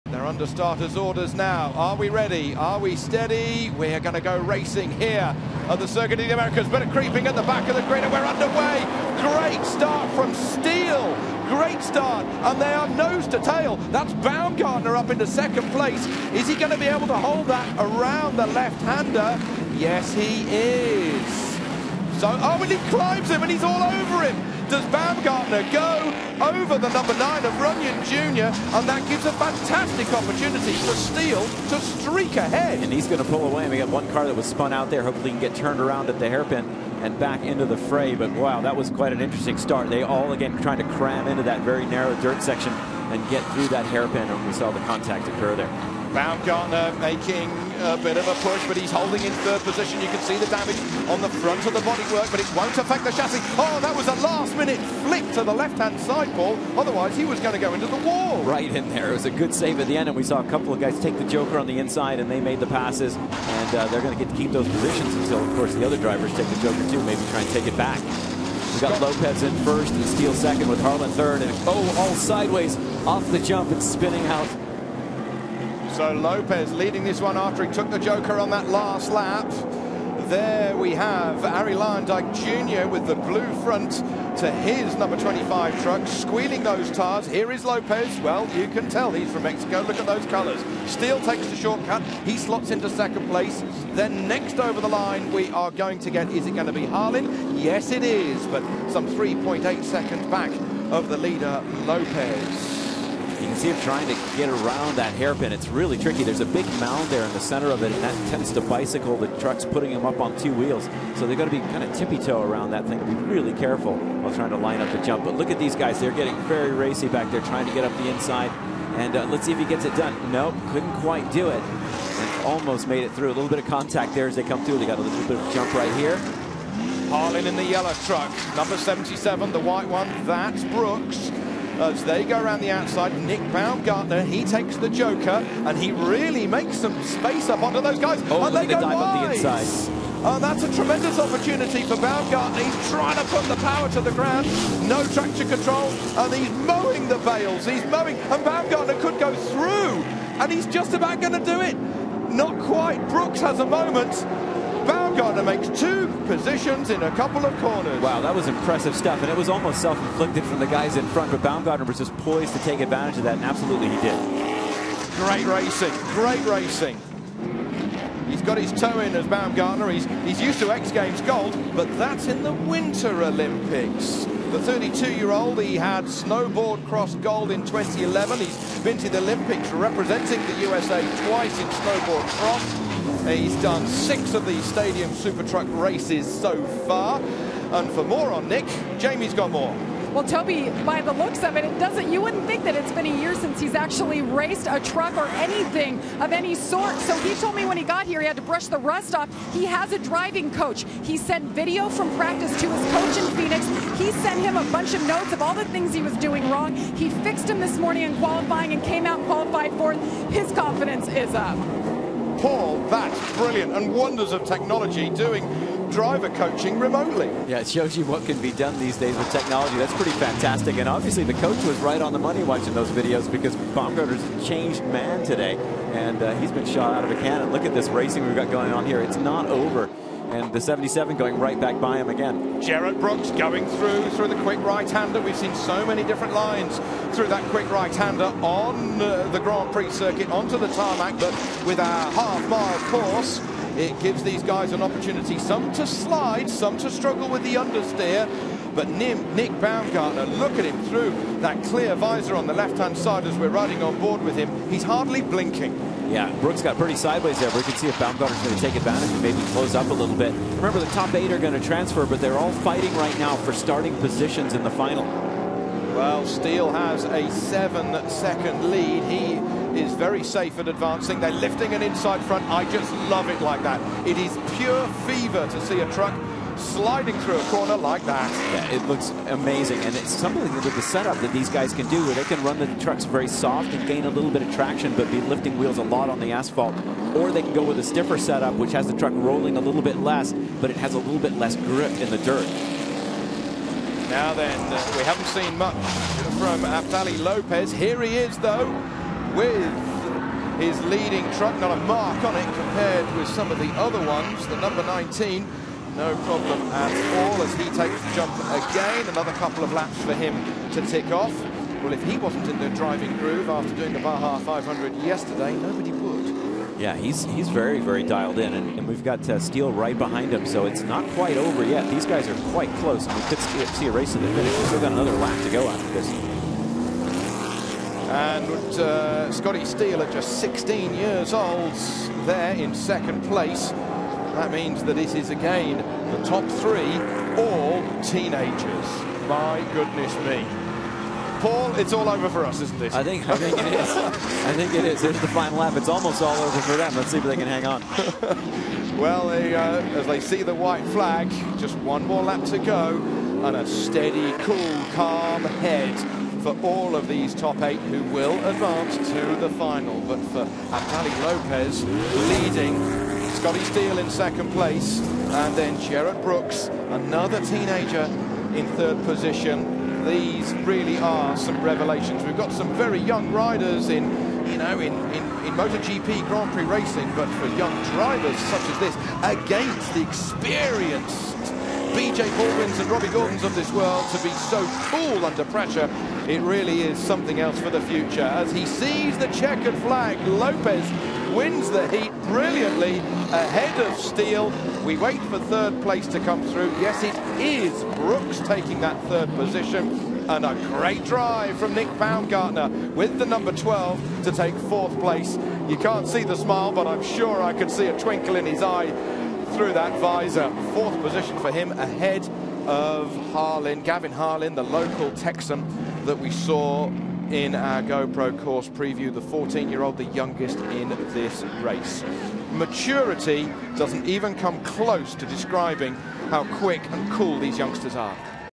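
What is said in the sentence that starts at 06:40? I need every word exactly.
And a great drive from Nick Baumgartner with the number 12 to take fourth place.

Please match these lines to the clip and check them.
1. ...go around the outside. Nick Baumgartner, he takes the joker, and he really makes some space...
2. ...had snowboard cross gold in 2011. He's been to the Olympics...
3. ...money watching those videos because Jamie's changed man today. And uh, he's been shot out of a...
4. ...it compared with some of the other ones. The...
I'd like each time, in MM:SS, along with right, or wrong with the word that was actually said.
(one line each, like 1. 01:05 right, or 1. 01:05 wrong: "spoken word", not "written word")
1. 02:12 right
2. 02:55 right
3. 03:42 wrong: "Baumgartner", not "Jamie"
4. 05:02 right.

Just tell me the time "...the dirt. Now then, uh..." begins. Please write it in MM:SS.
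04:52.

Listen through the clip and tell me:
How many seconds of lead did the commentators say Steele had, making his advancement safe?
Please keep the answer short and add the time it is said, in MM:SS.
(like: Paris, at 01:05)
7, at 04:27.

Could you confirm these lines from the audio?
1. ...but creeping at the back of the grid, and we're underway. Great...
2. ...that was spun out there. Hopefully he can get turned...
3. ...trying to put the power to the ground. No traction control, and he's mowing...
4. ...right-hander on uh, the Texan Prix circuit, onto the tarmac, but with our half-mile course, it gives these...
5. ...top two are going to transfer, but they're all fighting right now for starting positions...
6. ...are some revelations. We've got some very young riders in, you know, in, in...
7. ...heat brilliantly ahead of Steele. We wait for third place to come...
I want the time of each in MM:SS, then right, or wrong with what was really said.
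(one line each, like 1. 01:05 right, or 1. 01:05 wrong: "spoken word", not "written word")
1. 00:06 right
2. 00:34 right
3. 02:22 right
4. 03:57 wrong: "Grand", not "Texan"
5. 04:20 wrong: "eight", not "two"
6. 06:10 right
7. 06:31 right.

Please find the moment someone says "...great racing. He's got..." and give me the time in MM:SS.
02:46.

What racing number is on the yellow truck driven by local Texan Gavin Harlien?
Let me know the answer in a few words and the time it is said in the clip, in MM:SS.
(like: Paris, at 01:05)
77, at 02:08.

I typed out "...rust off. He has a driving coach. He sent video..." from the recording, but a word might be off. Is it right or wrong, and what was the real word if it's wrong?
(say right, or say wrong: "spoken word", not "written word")
right.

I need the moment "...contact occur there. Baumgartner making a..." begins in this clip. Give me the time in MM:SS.
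00:44.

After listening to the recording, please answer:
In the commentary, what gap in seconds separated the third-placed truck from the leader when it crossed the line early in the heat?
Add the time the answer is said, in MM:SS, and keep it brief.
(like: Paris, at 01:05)
3.8, at 01:39.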